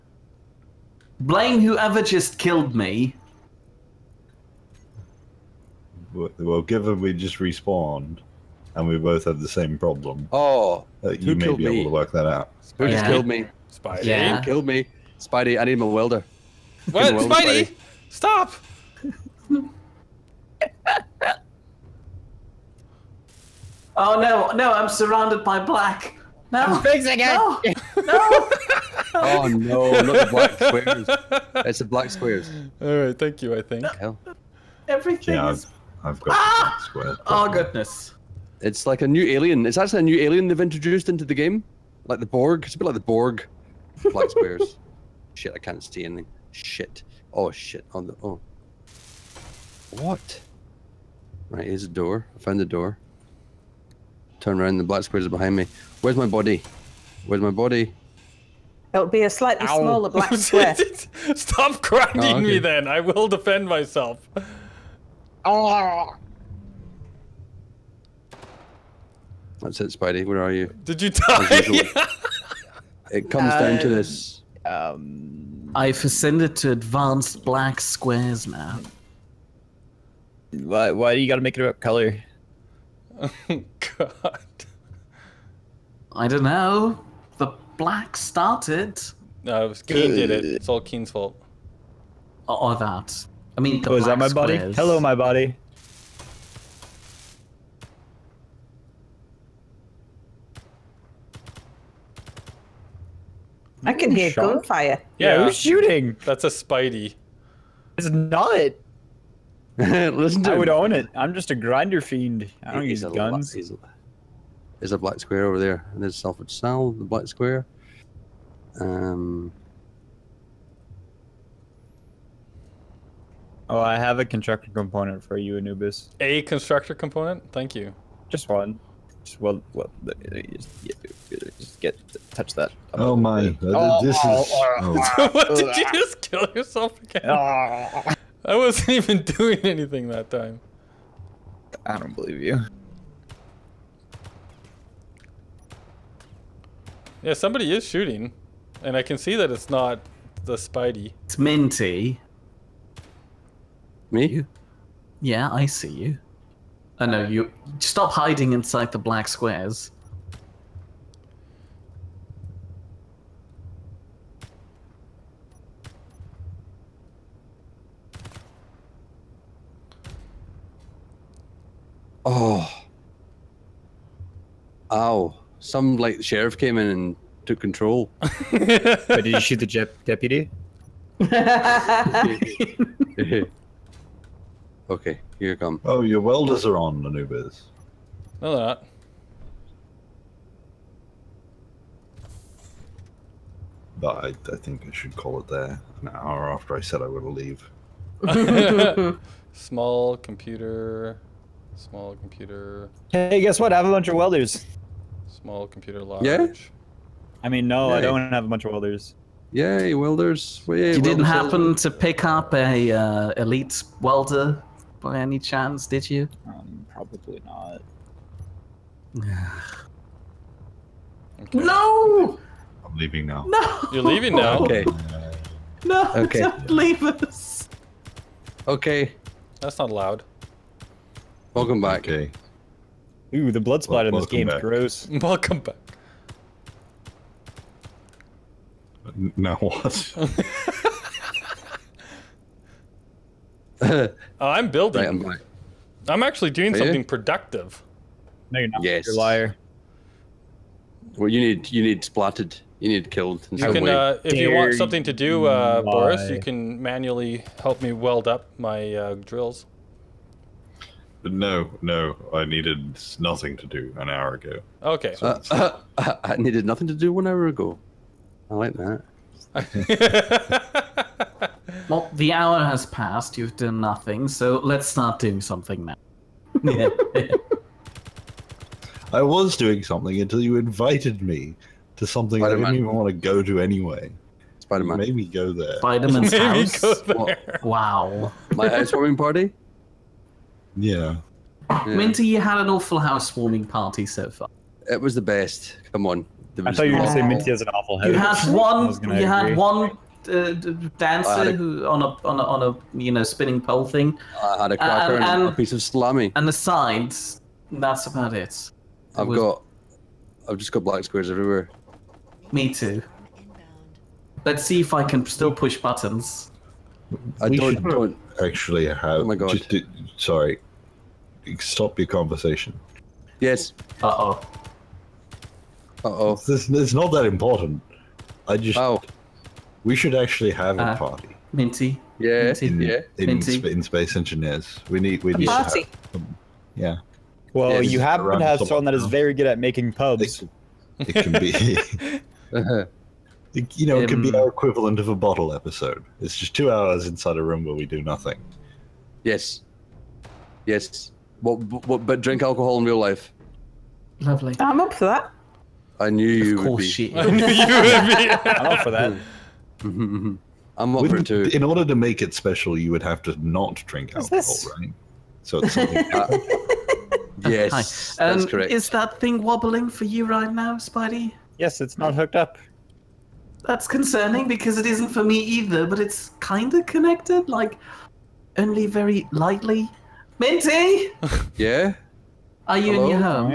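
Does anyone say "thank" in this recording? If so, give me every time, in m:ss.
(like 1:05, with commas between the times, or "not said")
0:33, 2:07.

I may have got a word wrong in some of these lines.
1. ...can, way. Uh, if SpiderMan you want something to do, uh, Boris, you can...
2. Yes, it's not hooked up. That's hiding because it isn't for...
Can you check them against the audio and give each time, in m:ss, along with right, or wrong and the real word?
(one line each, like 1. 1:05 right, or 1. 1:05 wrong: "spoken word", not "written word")
1. 4:13 wrong: "Dare", not "SpiderMan"
2. 6:11 wrong: "concerning", not "hiding".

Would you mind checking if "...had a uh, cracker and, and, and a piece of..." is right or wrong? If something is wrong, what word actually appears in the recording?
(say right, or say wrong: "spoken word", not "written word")
right.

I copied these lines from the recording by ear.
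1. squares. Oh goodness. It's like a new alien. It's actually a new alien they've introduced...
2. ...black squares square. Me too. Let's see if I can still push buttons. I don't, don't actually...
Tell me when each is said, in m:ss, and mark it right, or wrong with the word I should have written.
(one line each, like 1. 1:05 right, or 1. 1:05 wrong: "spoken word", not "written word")
1. 0:36 right
2. 5:10 wrong: "everywhere", not "square".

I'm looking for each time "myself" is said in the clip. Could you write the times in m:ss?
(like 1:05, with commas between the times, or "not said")
1:03.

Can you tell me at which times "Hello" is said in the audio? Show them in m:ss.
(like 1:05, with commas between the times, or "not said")
1:34, 6:22.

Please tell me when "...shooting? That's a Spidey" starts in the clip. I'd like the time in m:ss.
1:45.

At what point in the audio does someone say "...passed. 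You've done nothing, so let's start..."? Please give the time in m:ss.
4:32.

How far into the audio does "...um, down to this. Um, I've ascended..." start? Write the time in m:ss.
1:13.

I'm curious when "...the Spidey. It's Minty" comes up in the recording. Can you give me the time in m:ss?
2:30.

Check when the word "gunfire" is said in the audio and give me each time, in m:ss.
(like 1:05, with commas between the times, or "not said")
1:44.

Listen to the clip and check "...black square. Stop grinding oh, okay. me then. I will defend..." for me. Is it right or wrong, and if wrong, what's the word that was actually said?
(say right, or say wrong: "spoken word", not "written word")
right.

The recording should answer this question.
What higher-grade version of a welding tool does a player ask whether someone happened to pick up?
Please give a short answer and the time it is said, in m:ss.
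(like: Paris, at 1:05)
Elite welder, at 3:33.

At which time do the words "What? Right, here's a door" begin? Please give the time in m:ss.
0:50.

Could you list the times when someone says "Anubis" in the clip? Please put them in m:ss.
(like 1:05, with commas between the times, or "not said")
2:05, 3:07.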